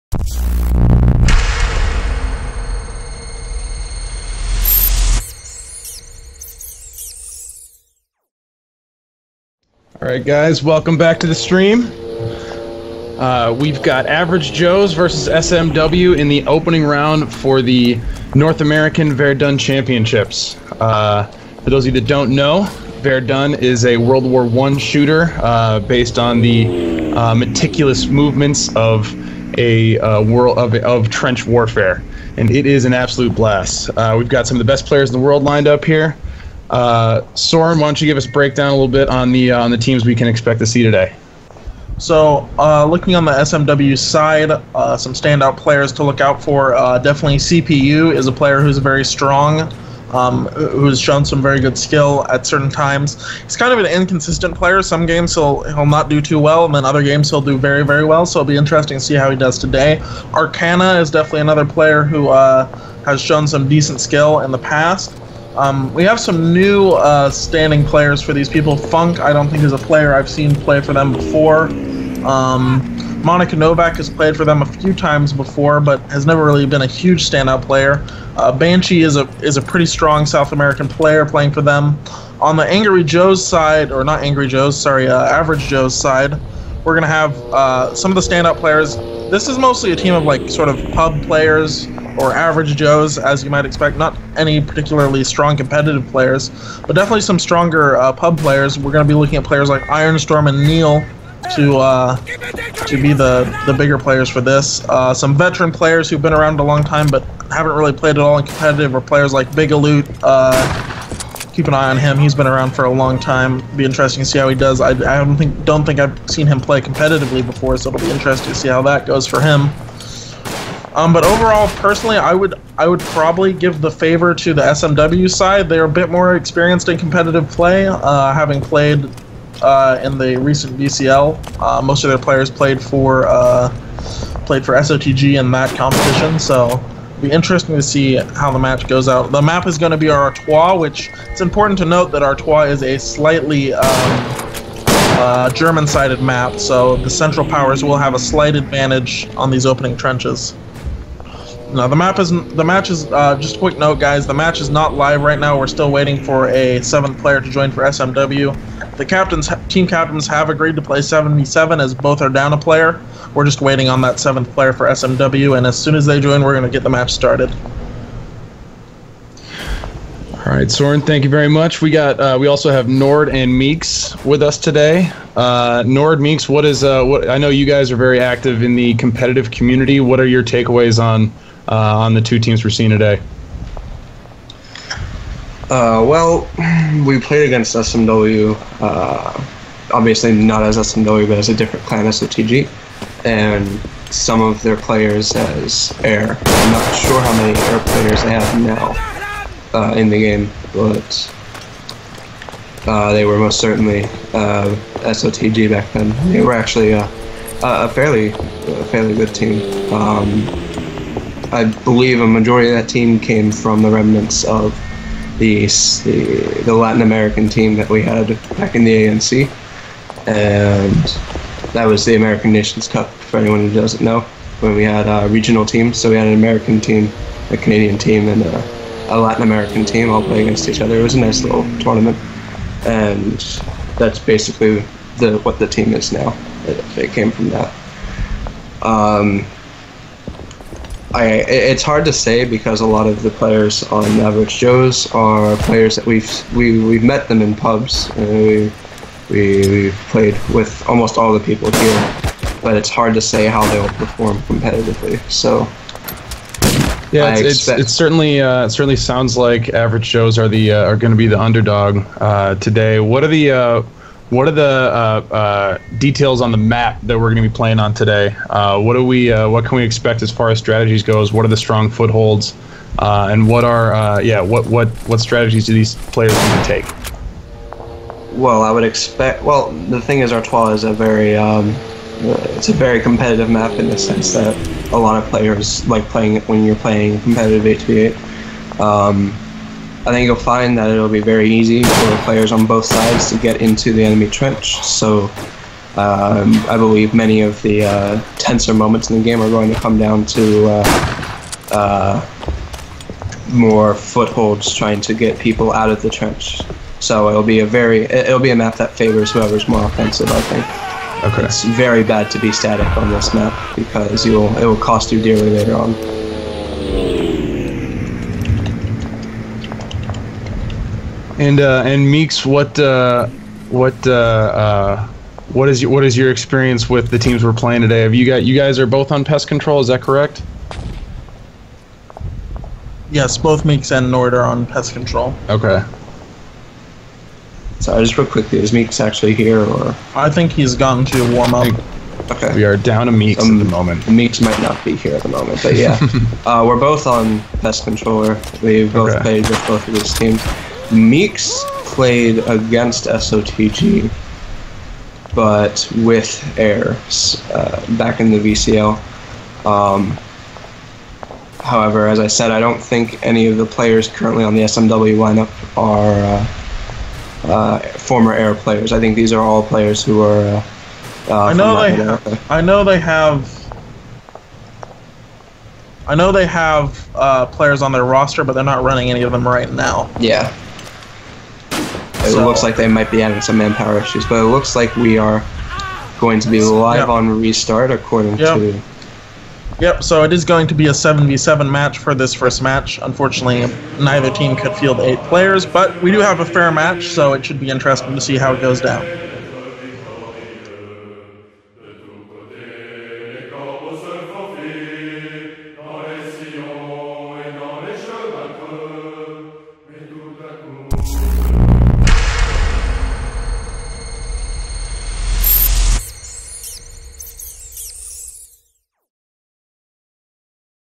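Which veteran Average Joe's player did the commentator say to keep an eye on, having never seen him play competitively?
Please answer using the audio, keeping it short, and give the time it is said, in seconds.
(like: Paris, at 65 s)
Bigaloot, at 109 s.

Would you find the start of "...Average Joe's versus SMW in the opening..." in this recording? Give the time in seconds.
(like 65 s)
14 s.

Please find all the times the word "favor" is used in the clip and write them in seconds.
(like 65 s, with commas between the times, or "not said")
123 s, 308 s.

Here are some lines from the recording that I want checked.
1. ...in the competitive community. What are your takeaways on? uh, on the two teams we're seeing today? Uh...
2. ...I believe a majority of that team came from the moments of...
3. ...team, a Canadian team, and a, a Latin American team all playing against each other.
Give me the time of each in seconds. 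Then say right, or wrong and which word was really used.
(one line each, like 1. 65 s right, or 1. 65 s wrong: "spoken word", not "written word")
1. 178 s right
2. 211 s wrong: "remnants", not "moments"
3. 226 s right.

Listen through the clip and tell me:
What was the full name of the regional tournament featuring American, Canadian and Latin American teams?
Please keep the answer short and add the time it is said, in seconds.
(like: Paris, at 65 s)
American Nations Cup, at 222 s.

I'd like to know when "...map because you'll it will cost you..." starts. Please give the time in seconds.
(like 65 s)
313 s.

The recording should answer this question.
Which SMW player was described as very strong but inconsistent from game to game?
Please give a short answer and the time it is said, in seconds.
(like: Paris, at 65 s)
CPU, at 47 s.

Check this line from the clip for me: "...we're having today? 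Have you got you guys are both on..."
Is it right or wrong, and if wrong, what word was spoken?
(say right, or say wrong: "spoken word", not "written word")
wrong: "playing", not "having".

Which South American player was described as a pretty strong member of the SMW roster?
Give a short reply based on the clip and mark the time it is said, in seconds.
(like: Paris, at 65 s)
Banshee, at 78 s.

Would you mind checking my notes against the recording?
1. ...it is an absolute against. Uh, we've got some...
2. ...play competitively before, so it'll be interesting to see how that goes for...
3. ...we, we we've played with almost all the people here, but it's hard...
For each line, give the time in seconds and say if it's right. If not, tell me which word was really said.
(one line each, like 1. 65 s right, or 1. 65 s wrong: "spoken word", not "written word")
1. 32 s wrong: "blast", not "against"
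2. 116 s right
3. 248 s right.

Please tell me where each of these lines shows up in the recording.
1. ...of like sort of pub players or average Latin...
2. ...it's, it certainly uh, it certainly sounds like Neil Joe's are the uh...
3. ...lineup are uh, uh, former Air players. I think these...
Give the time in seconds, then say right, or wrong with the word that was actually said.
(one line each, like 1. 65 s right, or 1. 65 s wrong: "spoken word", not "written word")
1. 90 s wrong: "Joes", not "Latin"
2. 257 s wrong: "Average", not "Neil"
3. 365 s right.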